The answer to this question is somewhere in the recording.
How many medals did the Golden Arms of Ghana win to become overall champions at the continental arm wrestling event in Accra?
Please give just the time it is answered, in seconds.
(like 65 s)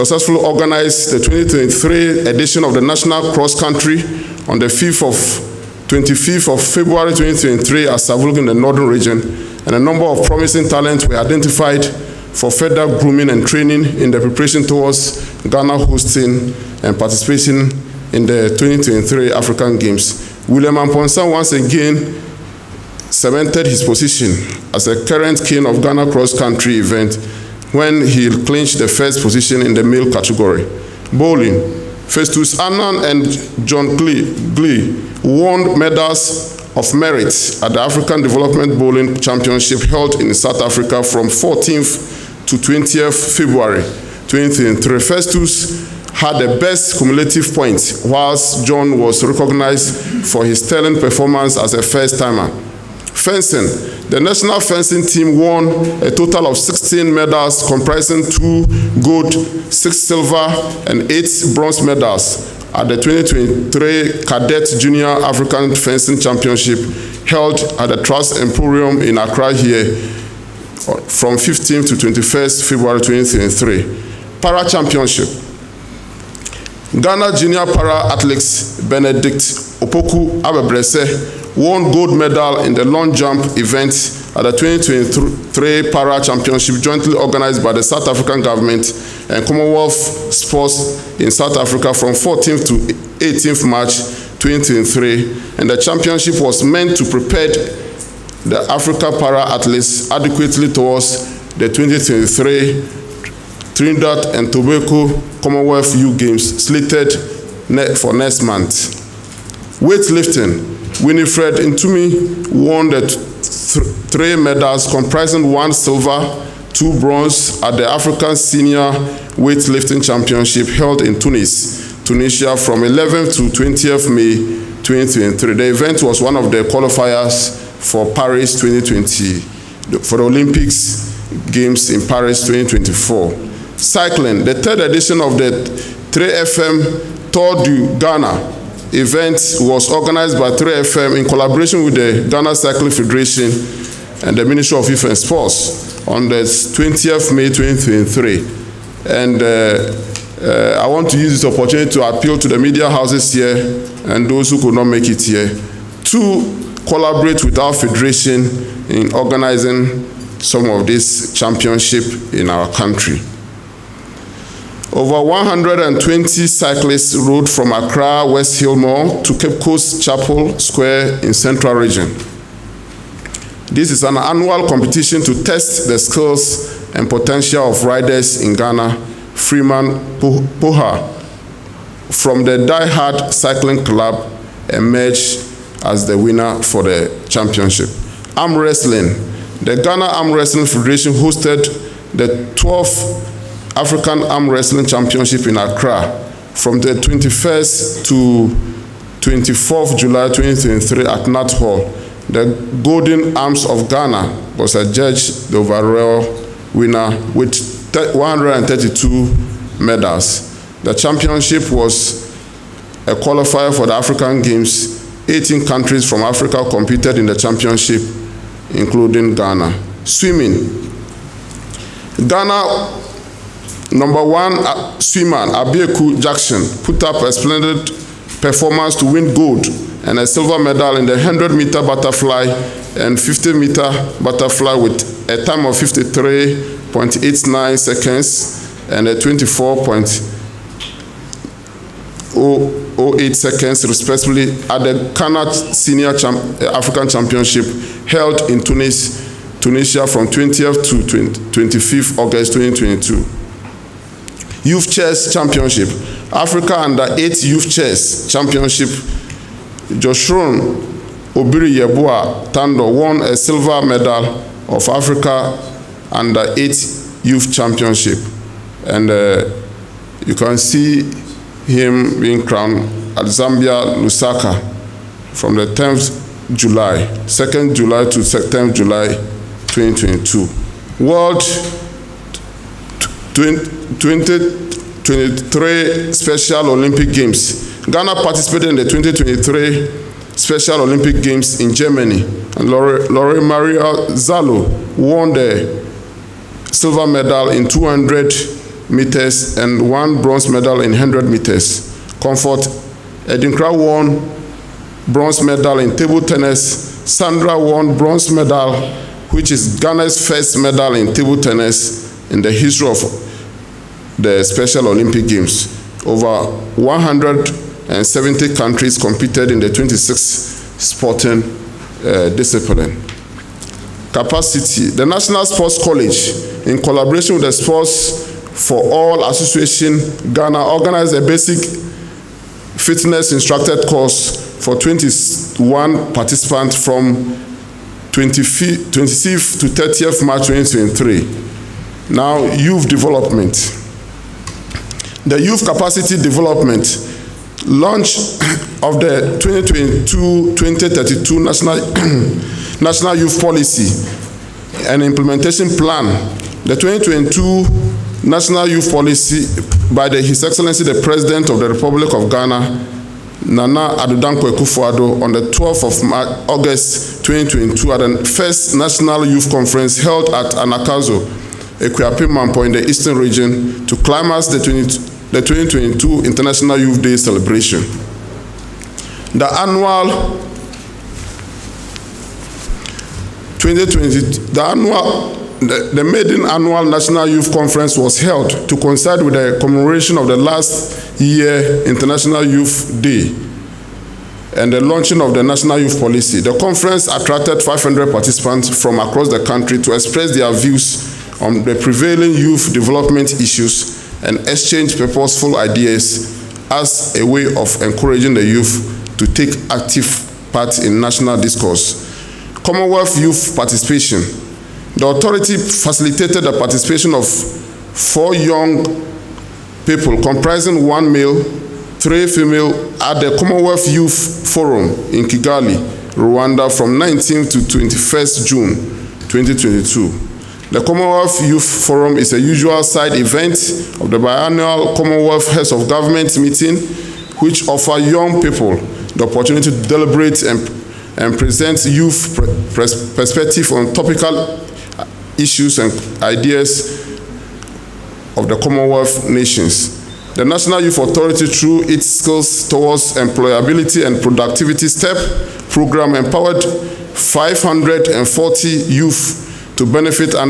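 208 s.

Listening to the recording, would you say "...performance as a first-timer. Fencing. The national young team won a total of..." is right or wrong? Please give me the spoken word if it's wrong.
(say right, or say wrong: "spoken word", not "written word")
wrong: "fencing", not "young".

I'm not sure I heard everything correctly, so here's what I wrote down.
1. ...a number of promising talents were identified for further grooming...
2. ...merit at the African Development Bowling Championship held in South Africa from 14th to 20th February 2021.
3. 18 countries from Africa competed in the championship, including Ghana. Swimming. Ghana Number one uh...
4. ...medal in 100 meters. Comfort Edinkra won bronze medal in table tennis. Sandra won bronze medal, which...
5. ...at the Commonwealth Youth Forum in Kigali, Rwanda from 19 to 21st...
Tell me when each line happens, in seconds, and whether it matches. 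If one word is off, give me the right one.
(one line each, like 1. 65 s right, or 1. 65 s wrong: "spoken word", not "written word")
1. 9 s right
2. 36 s wrong: "2023", not "2021"
3. 215 s right
4. 300 s right
5. 423 s right.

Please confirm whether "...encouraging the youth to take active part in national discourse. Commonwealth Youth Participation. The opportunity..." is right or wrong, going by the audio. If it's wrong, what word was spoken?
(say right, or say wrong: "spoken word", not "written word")
wrong: "authority", not "opportunity".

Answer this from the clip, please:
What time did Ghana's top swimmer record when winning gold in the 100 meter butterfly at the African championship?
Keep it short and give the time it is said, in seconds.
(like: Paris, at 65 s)
53.89 seconds, at 235 s.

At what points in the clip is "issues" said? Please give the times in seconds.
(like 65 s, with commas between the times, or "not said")
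403 s, 445 s.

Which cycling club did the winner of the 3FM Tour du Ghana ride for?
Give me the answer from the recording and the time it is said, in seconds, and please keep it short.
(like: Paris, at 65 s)
Die Hard Cycling Club, at 182 s.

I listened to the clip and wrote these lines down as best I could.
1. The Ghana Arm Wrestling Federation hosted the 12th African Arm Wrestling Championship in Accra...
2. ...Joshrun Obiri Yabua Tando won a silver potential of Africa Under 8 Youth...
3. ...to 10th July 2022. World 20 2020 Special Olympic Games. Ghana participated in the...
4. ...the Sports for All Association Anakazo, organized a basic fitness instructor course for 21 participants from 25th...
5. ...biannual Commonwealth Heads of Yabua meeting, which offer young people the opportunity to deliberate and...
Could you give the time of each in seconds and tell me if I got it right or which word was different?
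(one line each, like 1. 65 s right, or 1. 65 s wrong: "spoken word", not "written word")
1. 189 s right
2. 259 s wrong: "medal", not "potential"
3. 278 s wrong: "2023", not "2020"
4. 327 s wrong: "Ghana", not "Anakazo"
5. 434 s wrong: "Government", not "Yabua".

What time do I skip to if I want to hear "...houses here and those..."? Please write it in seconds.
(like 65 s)
152 s.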